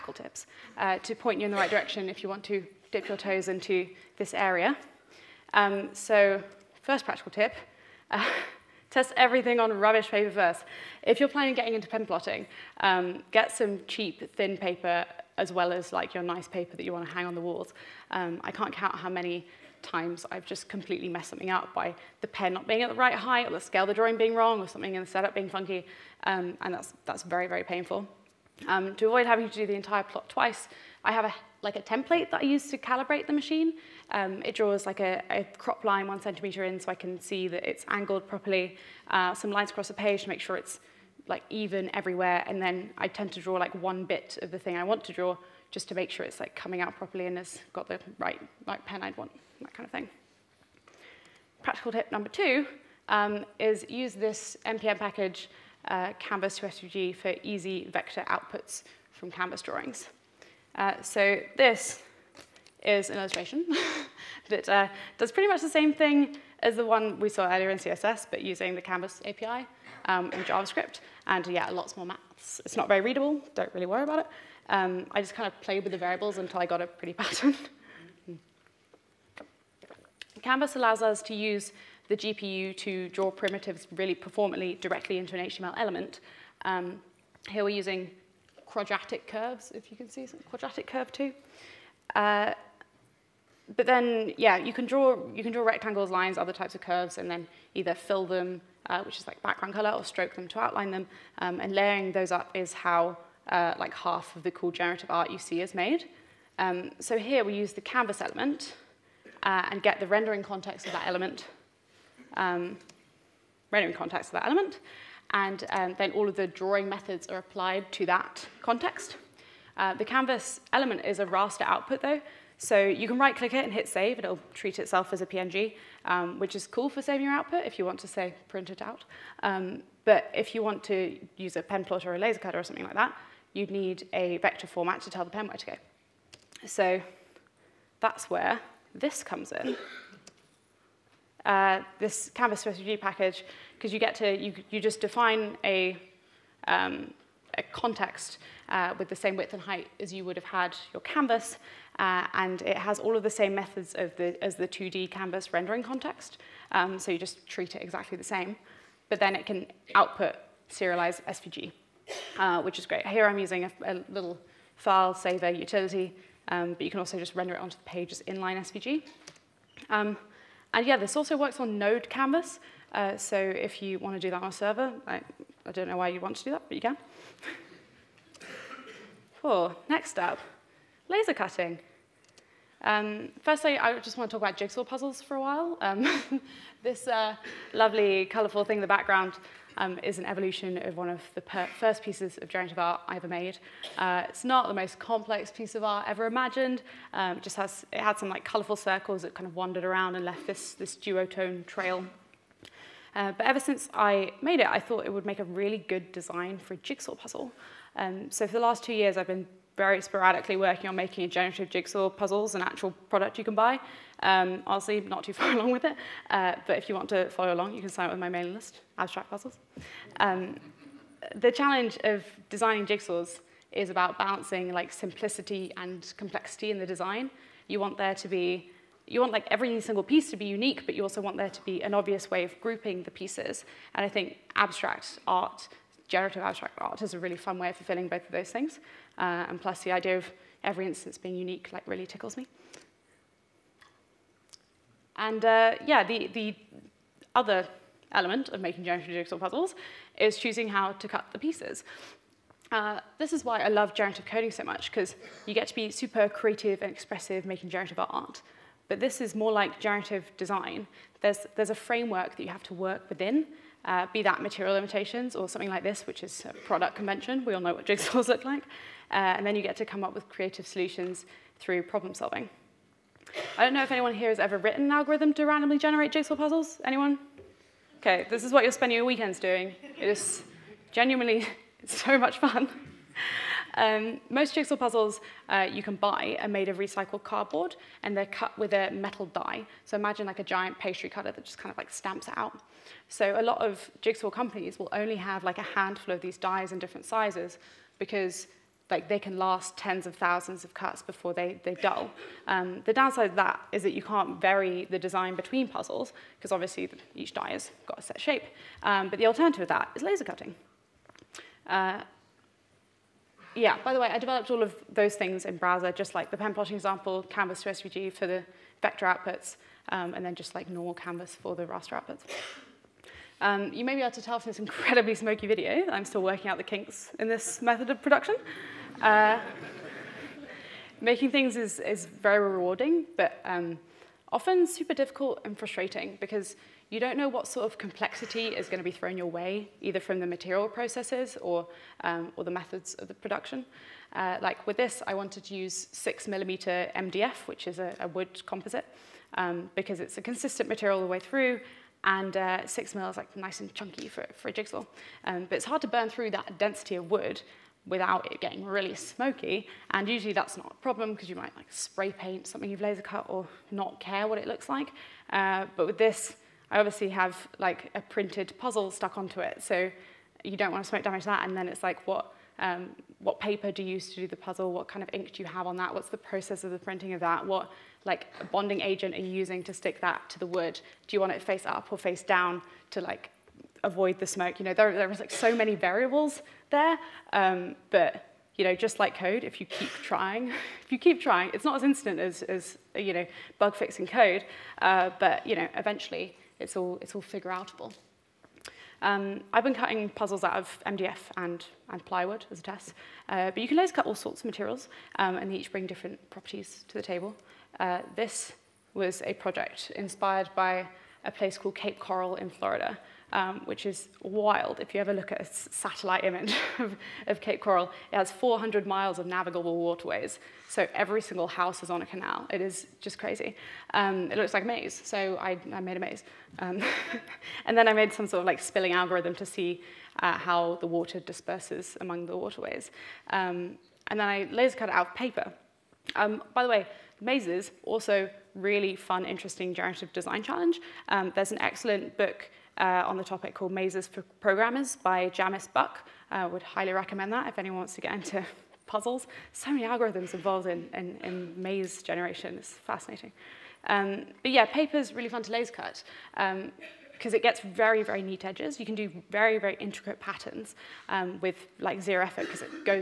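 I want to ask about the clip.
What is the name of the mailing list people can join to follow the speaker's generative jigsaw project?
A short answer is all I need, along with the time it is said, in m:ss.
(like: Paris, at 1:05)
Abstract Puzzles, at 3:38.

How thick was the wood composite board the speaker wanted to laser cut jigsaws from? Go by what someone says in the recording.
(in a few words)
6 millimeters.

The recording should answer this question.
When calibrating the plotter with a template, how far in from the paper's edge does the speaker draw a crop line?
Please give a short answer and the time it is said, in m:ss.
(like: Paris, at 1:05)
1 centimeter, at 0:36.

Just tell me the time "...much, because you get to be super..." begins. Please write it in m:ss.
4:14.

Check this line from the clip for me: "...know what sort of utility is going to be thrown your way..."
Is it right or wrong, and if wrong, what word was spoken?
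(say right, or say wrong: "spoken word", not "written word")
wrong: "complexity", not "utility".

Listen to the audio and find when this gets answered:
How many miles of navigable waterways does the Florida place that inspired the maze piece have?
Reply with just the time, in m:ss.
6:58.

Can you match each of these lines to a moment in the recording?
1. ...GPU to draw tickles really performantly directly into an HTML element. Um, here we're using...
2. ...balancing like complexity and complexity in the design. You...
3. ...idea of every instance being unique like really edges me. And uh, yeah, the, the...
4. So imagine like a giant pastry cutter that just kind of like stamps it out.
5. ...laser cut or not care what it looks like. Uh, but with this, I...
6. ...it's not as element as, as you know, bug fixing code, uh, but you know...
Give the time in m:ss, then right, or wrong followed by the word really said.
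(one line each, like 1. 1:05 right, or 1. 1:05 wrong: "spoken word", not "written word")
1. 1:22 wrong: "primitives", not "tickles"
2. 3:44 wrong: "simplicity", not "complexity"
3. 3:59 wrong: "tickles", not "edges"
4. 4:49 right
5. 6:02 right
6. 6:31 wrong: "instant", not "element".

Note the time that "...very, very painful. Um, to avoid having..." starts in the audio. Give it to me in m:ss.
0:27.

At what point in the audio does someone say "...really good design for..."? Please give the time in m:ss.
3:25.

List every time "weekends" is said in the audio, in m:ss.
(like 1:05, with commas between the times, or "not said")
4:39.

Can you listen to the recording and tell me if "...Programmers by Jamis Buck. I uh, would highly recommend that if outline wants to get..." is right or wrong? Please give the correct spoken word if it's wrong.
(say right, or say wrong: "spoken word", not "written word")
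wrong: "anyone", not "outline".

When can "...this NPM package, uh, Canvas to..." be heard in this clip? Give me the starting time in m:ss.
0:54.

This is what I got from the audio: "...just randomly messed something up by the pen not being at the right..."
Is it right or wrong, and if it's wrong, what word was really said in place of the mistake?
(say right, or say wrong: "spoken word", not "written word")
wrong: "completely", not "randomly".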